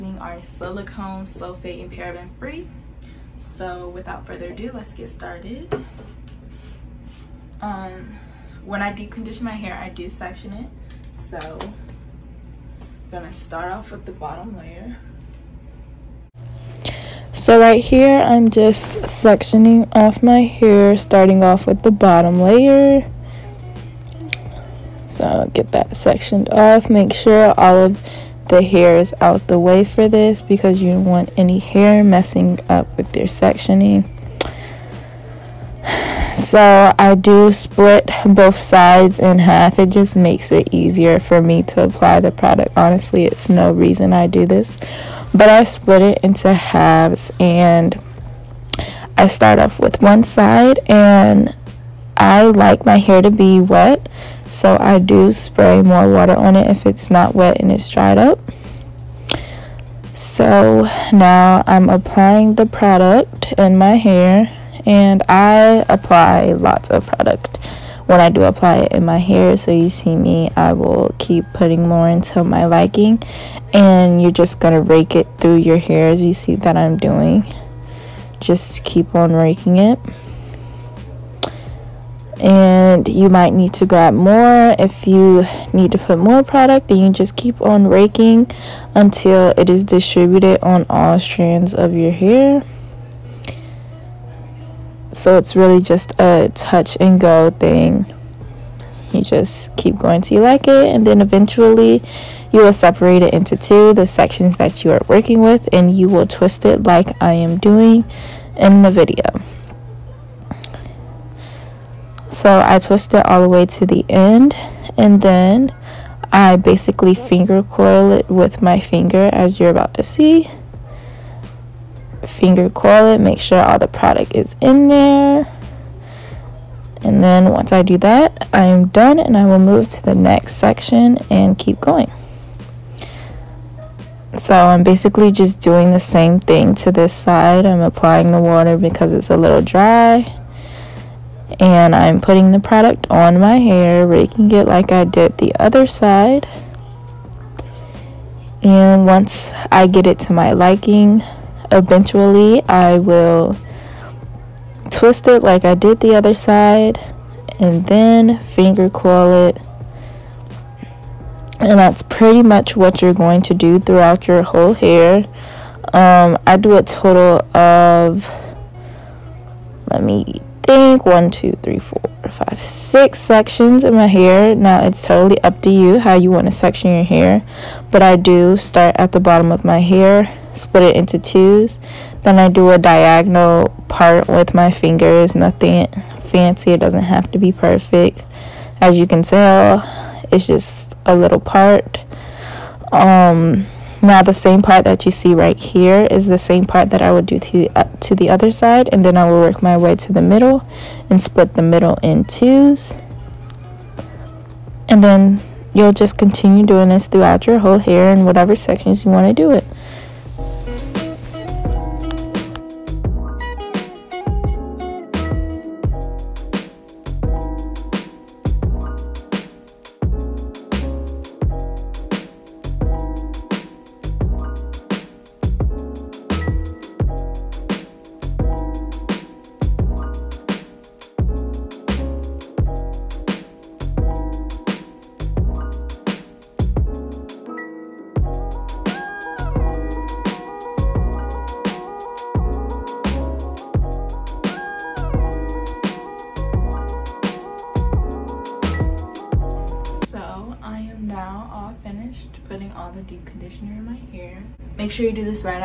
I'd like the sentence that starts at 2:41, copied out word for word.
And that's pretty much what you're going to do throughout your whole hair.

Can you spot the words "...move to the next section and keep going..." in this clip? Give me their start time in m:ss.
2:09.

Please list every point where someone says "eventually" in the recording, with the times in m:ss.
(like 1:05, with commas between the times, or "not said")
1:41, 2:31.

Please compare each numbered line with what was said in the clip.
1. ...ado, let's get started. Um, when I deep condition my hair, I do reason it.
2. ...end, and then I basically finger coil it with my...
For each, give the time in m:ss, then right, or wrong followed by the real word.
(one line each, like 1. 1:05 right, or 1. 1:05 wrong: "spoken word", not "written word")
1. 0:04 wrong: "section", not "reason"
2. 1:54 right.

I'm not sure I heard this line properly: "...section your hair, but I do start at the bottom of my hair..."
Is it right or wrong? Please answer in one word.
right.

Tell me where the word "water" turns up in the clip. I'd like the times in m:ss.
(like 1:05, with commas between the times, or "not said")
0:56, 2:18.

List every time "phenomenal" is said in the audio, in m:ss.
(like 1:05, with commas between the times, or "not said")
not said.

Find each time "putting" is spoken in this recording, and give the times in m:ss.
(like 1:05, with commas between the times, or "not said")
1:11, 2:22.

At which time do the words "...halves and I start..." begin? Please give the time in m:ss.
0:46.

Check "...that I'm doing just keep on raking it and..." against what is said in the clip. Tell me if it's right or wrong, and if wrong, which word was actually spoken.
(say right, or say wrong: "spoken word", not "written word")
right.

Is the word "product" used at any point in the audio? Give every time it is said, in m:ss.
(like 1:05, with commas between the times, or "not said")
0:42, 1:02, 1:07, 1:26, 2:03, 2:22.